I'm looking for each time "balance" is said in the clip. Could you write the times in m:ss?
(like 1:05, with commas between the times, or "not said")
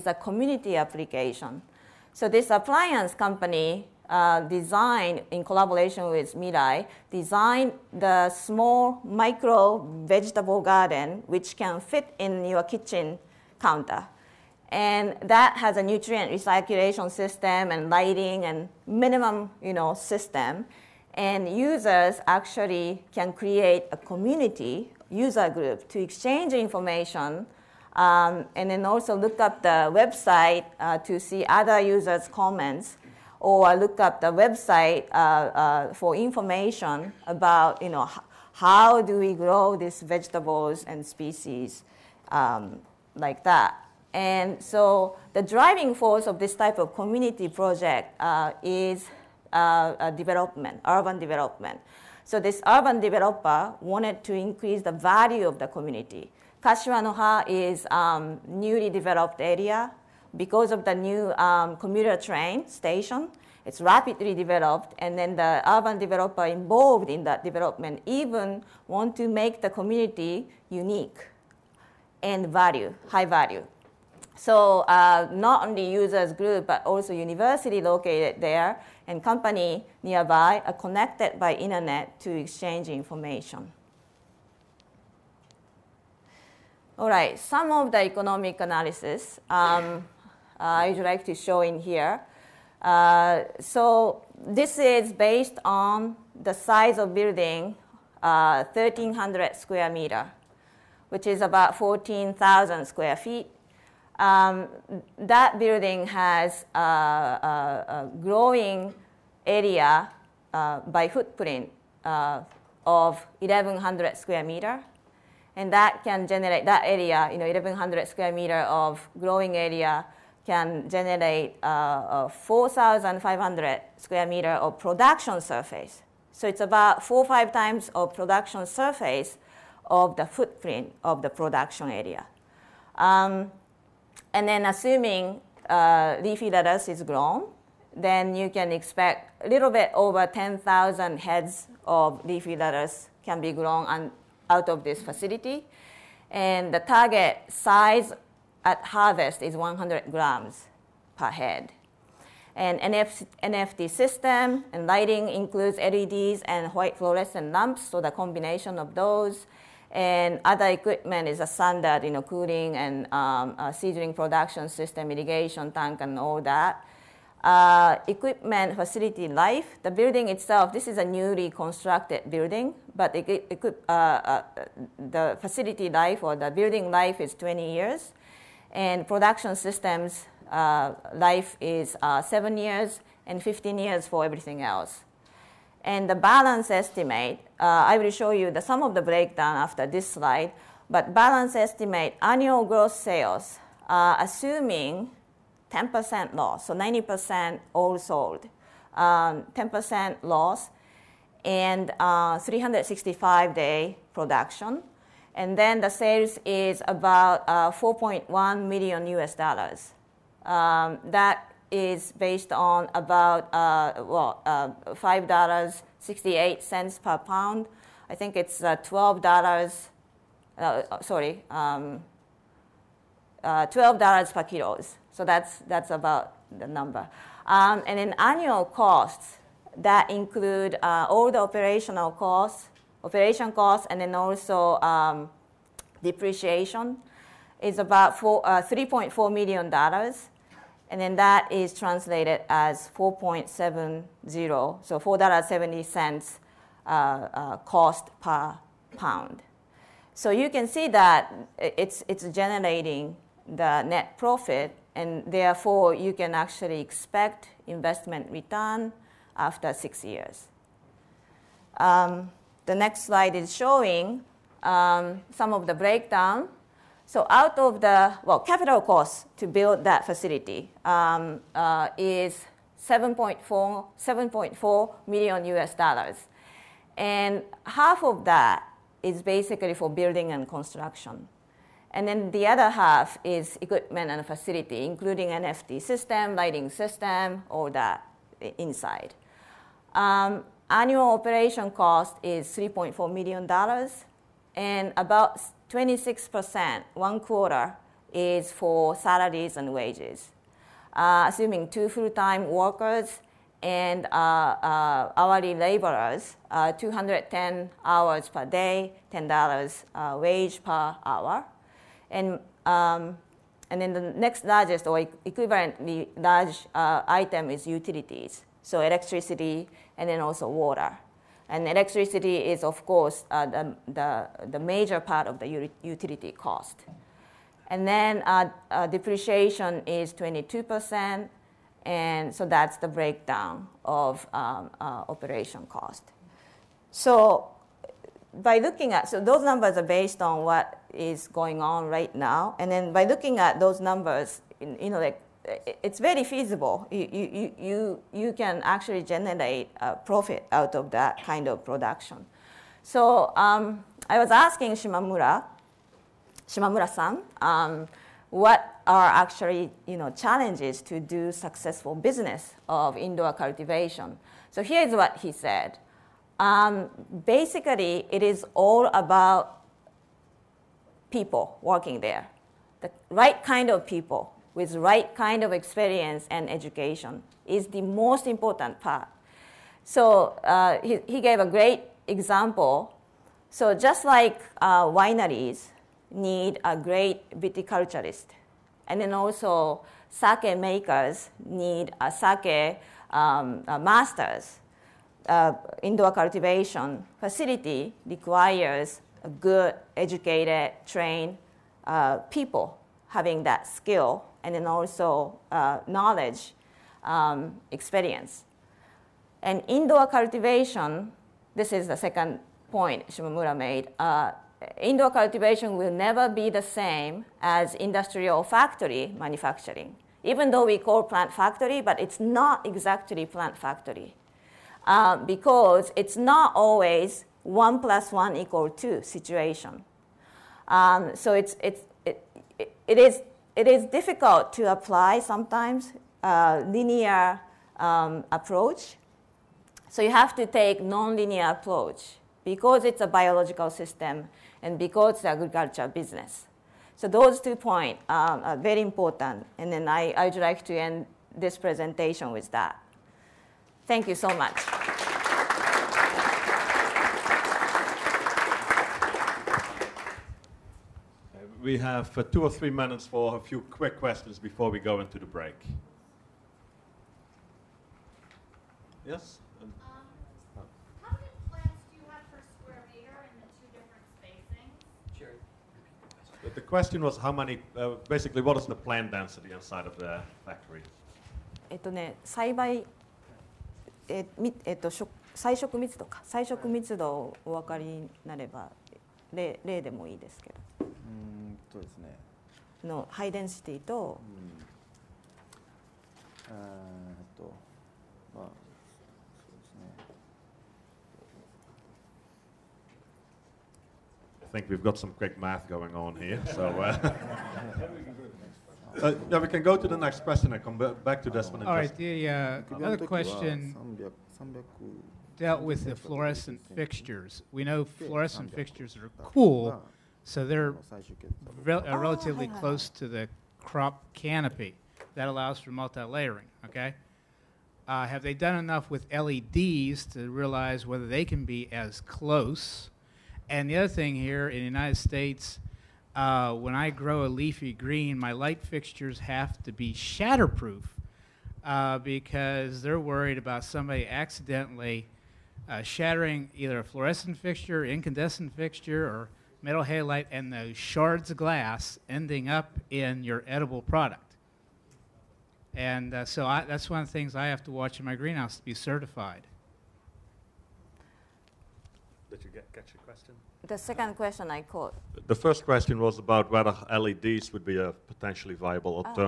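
3:06, 3:11.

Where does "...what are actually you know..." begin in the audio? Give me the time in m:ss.
5:58.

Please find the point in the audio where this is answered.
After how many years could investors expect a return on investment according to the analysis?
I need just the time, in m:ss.
4:19.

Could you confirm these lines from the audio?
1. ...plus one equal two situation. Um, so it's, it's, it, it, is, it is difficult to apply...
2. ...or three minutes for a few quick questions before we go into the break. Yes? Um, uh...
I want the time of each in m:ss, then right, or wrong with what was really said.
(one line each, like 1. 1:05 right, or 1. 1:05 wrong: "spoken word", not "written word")
1. 7:07 right
2. 7:42 right.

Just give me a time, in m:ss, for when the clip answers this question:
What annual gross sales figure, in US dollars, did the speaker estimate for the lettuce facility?
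3:27.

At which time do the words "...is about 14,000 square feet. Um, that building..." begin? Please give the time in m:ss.
1:41.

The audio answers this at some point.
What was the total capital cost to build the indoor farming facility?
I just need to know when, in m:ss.
4:33.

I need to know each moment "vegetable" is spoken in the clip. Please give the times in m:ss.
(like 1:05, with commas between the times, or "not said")
0:10, 0:40.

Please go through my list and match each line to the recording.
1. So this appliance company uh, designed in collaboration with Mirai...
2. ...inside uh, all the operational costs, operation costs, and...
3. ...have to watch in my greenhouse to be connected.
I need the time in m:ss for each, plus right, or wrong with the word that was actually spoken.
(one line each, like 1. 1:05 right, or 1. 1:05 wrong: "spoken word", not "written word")
1. 0:02 right
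2. 3:50 wrong: "include", not "inside"
3. 9:17 wrong: "certified", not "connected".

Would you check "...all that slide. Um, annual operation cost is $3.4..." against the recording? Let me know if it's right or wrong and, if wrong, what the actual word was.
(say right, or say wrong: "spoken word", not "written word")
wrong: "inside", not "slide".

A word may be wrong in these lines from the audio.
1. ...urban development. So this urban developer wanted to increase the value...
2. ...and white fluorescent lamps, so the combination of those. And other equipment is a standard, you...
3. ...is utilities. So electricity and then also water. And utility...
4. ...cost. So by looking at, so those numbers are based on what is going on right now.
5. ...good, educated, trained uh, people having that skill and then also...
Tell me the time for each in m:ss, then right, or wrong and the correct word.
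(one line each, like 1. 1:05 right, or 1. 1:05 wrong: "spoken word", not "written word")
1. 0:50 right
2. 2:36 right
3. 5:17 wrong: "electricity", not "utility"
4. 5:35 right
5. 6:39 right.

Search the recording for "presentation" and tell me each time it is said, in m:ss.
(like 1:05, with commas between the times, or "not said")
7:31.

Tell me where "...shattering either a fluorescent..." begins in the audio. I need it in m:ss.
9:05.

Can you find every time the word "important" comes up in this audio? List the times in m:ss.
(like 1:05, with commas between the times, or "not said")
6:18, 7:28.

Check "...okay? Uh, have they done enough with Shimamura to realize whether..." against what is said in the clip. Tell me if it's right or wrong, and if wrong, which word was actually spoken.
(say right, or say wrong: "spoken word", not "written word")
wrong: "LEDs", not "Shimamura".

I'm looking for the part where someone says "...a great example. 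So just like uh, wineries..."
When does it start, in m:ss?
6:21.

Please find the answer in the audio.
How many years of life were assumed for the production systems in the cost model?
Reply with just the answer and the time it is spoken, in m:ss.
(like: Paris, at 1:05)
7 years, at 3:02.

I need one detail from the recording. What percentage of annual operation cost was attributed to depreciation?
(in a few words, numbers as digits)
22%.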